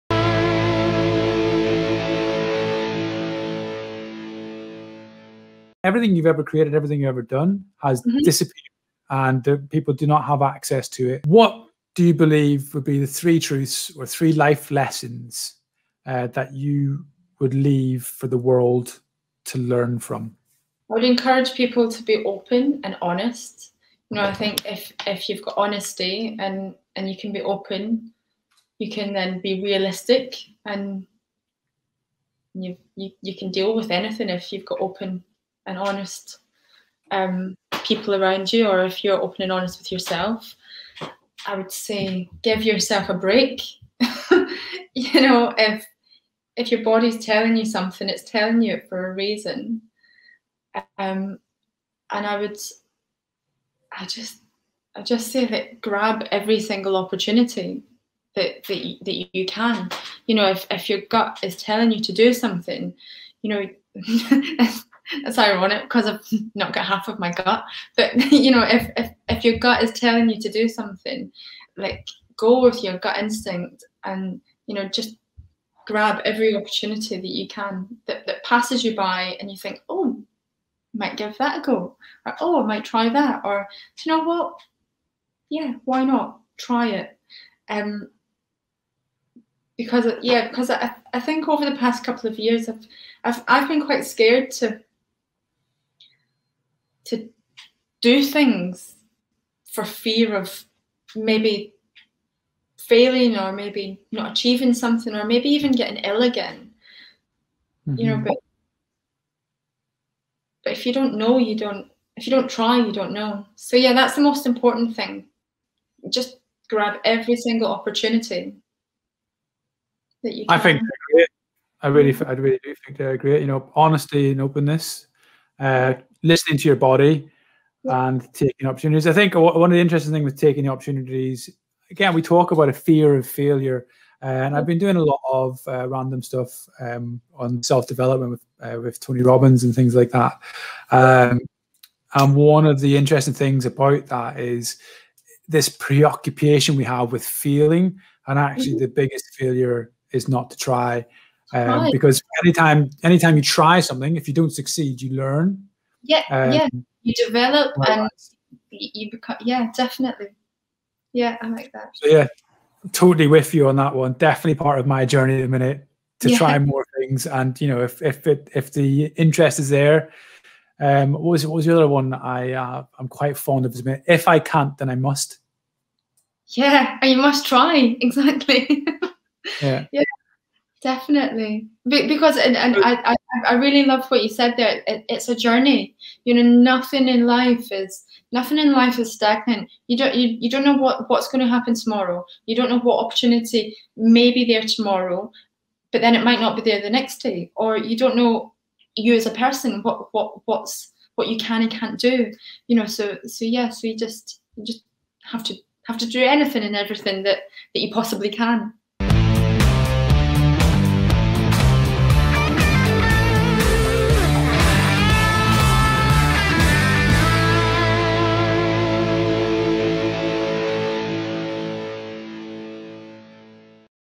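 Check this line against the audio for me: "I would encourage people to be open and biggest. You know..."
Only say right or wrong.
wrong.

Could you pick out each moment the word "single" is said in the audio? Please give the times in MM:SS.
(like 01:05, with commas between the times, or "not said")
00:56, 01:57.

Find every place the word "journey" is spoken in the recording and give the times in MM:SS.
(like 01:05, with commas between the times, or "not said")
02:45, 03:05.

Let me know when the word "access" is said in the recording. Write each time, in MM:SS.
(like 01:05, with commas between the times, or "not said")
00:10.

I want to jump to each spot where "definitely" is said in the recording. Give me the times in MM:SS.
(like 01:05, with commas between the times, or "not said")
02:39, 02:44, 03:00.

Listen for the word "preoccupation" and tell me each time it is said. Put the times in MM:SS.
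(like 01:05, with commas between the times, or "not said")
02:25.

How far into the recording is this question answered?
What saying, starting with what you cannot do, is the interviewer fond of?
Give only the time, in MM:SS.
02:54.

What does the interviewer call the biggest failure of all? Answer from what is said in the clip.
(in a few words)
not to try.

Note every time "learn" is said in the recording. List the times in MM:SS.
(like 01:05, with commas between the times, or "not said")
00:19, 02:35.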